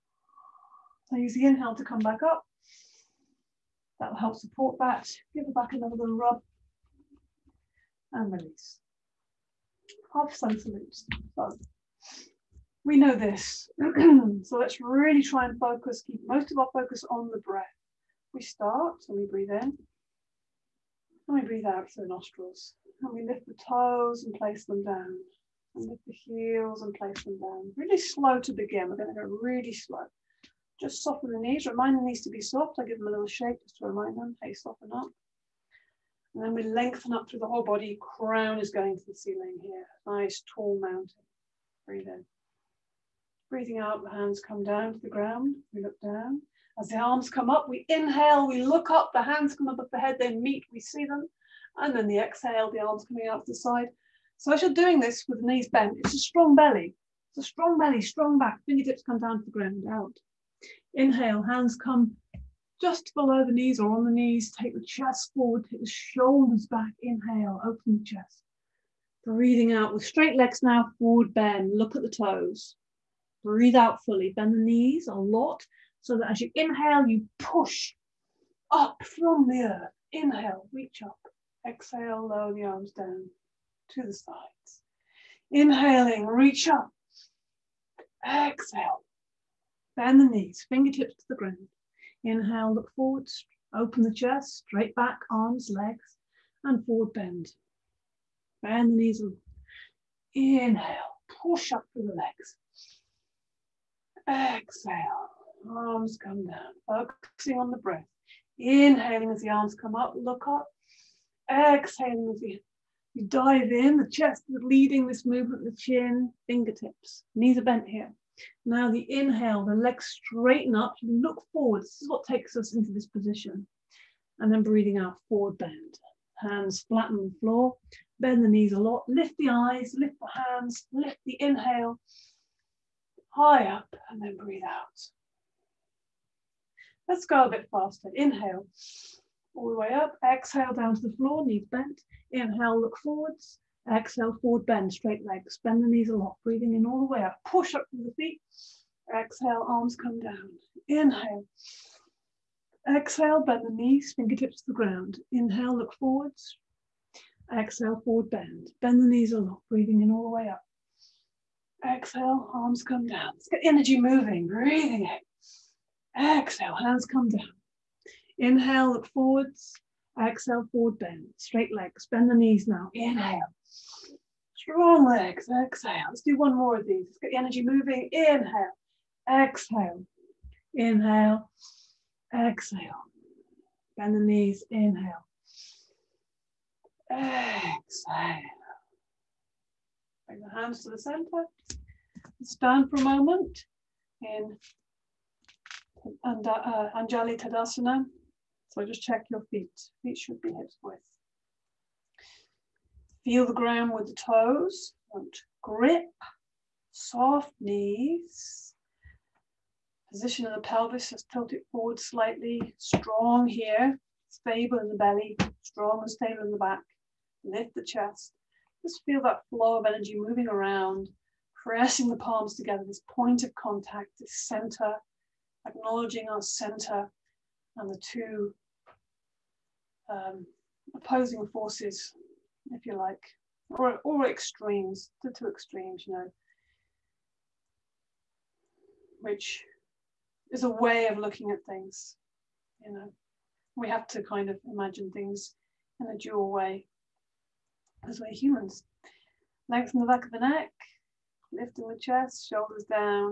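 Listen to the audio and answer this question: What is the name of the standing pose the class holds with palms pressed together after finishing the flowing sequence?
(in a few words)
Anjali Tadasana.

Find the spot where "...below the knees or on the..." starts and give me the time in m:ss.
1:03.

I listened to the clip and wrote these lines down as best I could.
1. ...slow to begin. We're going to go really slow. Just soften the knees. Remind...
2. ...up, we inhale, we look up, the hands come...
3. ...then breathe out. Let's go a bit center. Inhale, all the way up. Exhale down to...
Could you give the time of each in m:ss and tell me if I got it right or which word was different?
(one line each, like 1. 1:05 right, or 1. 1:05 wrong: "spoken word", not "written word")
1. 0:27 right
2. 0:47 right
3. 2:14 wrong: "faster", not "center".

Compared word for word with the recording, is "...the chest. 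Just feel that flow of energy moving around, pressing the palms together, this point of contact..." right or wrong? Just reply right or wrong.
right.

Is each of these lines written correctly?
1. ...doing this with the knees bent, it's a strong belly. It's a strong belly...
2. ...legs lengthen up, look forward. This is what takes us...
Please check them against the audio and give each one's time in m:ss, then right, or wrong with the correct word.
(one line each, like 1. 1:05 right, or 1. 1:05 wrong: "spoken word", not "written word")
1. 0:54 right
2. 1:59 wrong: "straighten", not "lengthen".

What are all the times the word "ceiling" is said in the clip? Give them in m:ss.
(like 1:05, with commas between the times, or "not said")
0:39.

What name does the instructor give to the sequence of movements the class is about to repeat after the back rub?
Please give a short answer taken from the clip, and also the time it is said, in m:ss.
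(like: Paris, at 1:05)
Half sun salutes, at 0:10.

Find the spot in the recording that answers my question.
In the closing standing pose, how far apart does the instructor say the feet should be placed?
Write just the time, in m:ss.
3:20.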